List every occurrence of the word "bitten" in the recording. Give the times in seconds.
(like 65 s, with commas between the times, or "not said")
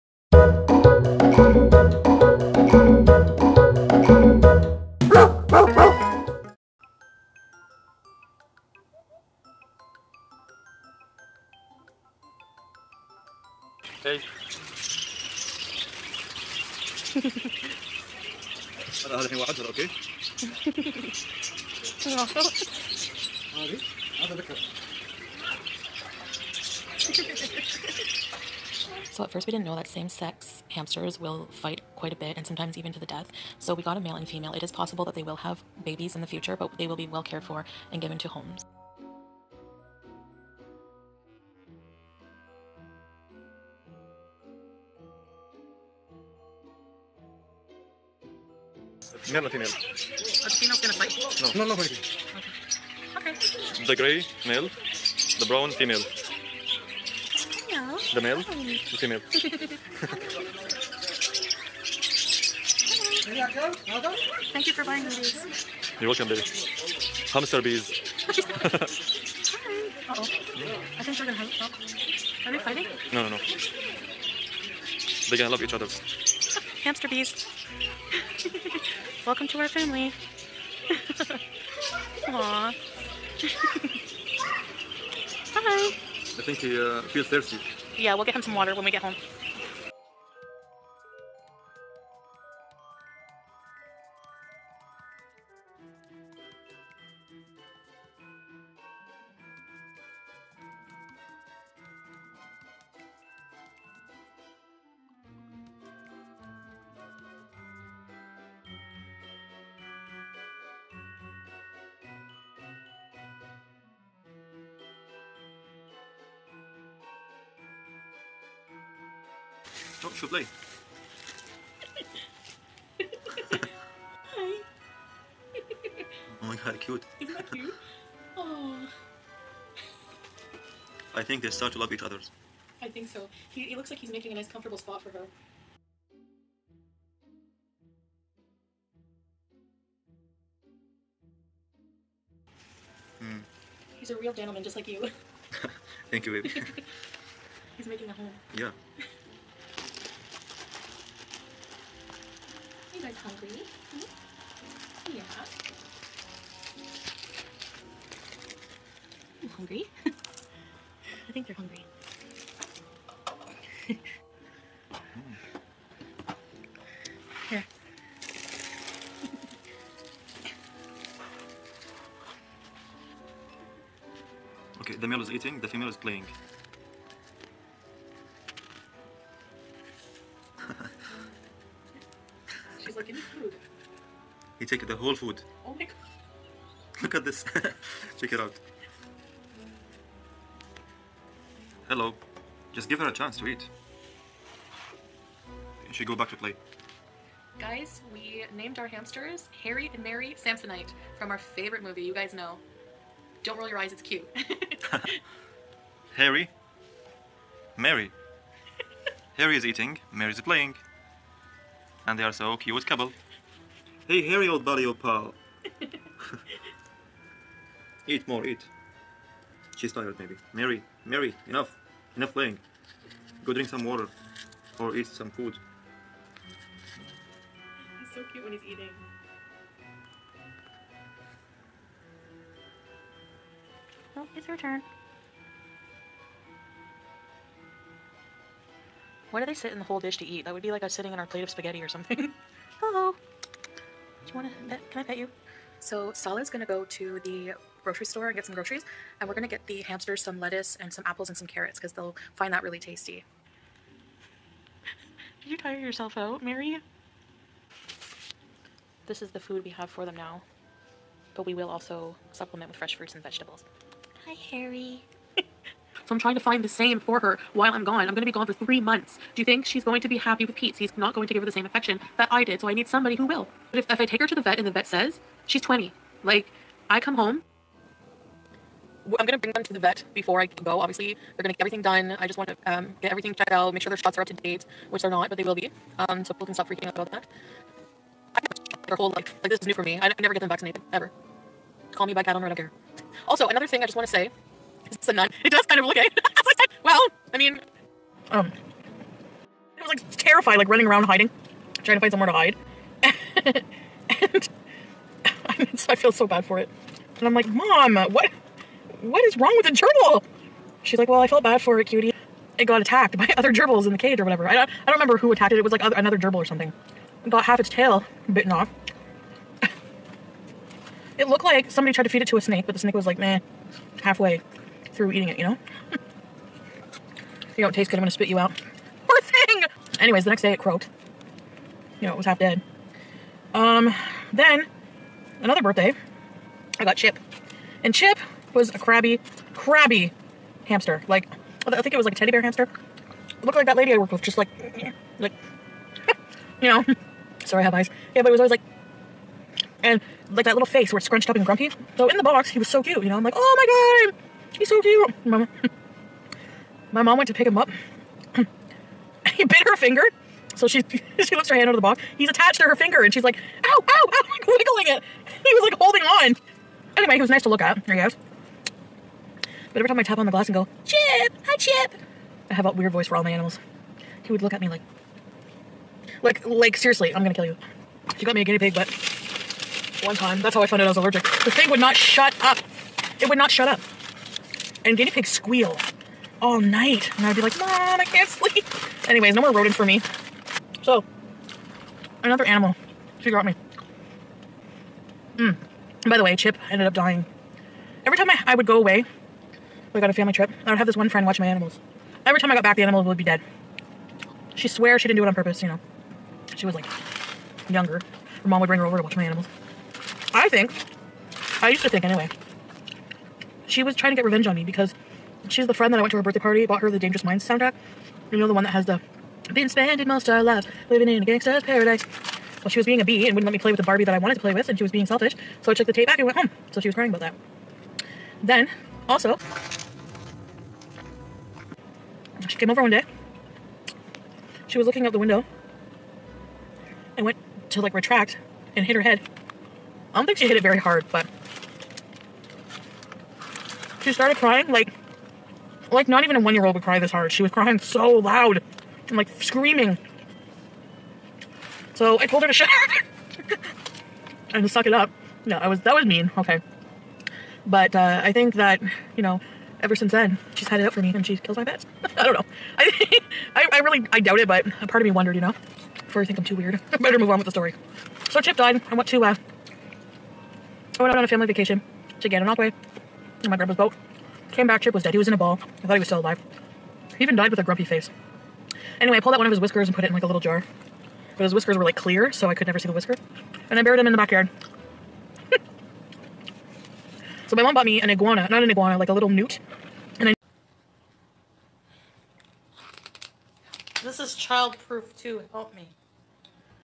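318 s.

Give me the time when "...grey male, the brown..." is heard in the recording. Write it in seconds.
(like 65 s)
53 s.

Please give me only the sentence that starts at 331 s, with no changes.
You know, it was half dead.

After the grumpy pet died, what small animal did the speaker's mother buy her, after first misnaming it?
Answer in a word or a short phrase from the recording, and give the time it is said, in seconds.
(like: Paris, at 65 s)
newt, at 489 s.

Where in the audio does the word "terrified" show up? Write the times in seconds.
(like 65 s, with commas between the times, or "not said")
300 s.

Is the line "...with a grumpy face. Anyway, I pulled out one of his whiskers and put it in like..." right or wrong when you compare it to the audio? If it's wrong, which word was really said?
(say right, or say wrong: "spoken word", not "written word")
right.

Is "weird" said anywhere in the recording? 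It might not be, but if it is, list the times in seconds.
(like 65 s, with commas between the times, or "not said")
372 s, 466 s.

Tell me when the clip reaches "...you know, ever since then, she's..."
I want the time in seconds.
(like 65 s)
459 s.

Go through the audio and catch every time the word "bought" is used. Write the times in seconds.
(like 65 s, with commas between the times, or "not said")
416 s, 487 s.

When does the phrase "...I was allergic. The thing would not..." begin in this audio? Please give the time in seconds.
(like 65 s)
380 s.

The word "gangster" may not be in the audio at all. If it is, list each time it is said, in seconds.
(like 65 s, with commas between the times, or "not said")
421 s.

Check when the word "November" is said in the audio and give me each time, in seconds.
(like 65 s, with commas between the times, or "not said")
not said.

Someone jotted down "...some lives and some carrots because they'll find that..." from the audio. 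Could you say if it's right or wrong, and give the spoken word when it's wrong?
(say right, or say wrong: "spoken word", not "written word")
wrong: "apples", not "lives".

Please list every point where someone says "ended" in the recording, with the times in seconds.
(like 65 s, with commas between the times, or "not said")
396 s.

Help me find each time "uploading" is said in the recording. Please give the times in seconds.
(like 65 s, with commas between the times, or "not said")
not said.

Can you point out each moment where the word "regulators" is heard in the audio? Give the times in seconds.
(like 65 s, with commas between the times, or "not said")
not said.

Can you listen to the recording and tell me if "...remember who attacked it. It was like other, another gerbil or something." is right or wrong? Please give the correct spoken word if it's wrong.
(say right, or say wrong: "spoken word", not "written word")
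right.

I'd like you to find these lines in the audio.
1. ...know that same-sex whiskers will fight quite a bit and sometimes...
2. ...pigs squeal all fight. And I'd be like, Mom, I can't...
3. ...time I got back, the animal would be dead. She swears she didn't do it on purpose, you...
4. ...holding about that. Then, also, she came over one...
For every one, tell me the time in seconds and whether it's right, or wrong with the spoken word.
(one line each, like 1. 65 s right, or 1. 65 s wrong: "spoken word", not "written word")
1. 29 s wrong: "hamsters", not "whiskers"
2. 385 s wrong: "night", not "fight"
3. 402 s right
4. 426 s wrong: "crying", not "holding".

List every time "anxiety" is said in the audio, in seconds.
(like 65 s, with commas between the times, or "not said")
not said.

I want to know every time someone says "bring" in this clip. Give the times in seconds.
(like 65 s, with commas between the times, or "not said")
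279 s, 408 s.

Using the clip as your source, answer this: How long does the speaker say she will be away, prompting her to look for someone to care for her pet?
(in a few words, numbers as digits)
3 months.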